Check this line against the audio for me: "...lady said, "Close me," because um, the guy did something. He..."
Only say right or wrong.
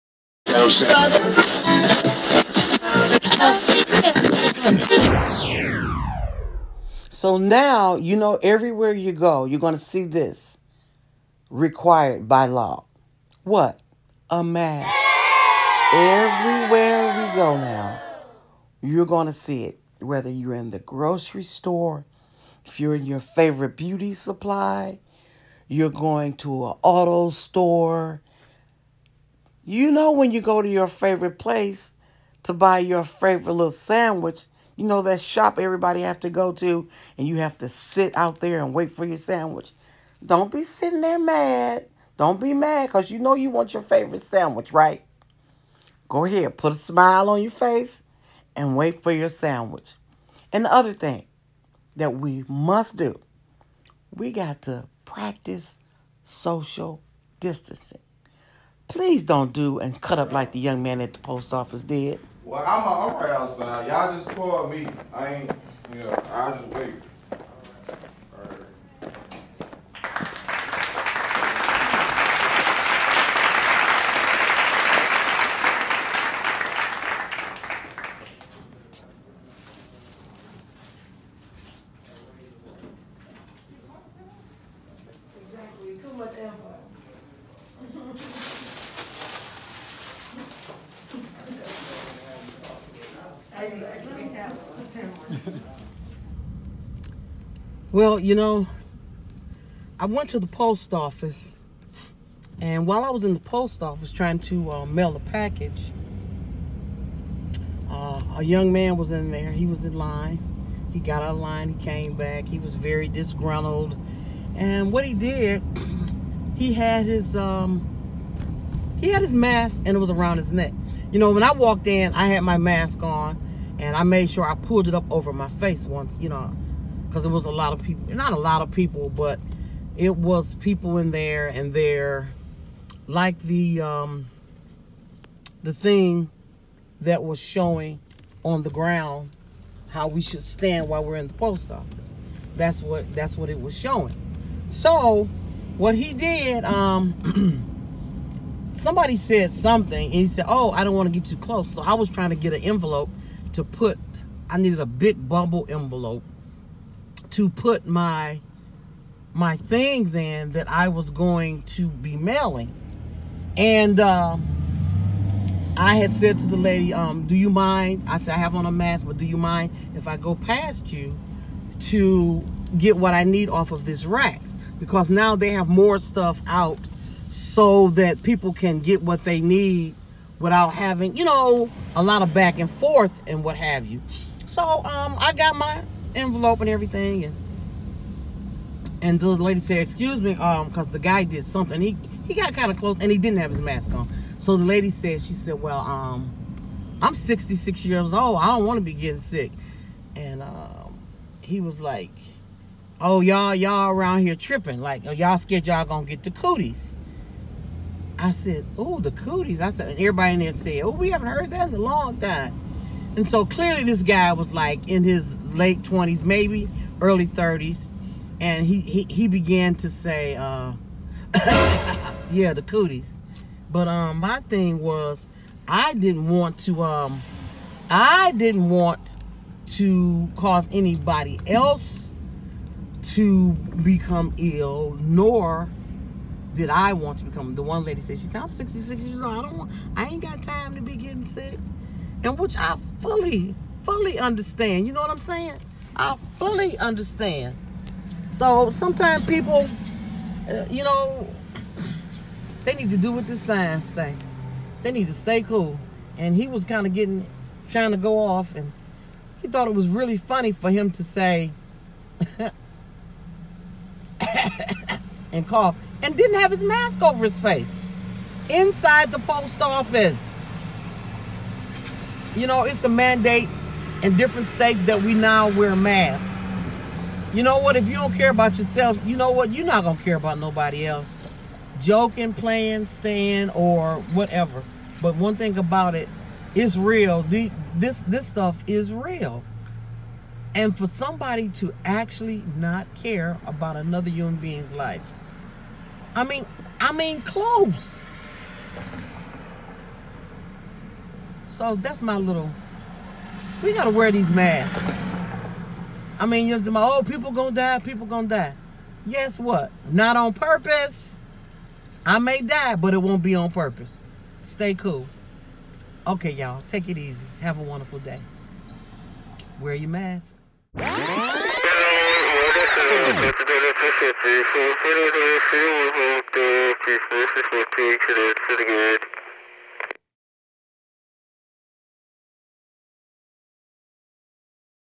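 wrong.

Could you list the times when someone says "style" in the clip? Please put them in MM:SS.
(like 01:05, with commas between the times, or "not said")
not said.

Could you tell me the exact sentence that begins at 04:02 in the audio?
And which I fully, fully understand.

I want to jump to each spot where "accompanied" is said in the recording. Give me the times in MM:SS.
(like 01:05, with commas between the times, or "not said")
not said.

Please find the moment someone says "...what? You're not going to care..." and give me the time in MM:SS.
04:39.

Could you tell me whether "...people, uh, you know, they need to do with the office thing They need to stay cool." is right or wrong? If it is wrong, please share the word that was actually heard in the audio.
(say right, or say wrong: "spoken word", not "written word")
wrong: "science", not "office".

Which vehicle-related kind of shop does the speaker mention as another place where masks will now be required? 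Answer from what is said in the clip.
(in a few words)
auto store.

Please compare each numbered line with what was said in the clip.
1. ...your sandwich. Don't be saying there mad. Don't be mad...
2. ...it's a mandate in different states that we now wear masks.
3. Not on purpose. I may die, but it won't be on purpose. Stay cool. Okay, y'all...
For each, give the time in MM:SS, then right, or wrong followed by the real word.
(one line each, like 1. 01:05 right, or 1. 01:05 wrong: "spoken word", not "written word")
1. 00:39 wrong: "sitting", not "saying"
2. 04:32 right
3. 05:09 right.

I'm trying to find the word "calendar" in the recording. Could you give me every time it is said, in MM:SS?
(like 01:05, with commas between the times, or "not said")
not said.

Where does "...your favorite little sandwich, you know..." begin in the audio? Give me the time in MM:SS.
00:32.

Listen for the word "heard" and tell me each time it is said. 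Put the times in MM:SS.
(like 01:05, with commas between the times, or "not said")
03:31.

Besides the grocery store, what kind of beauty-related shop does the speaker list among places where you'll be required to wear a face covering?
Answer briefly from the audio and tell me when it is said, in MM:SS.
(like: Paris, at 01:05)
beauty supply, at 00:23.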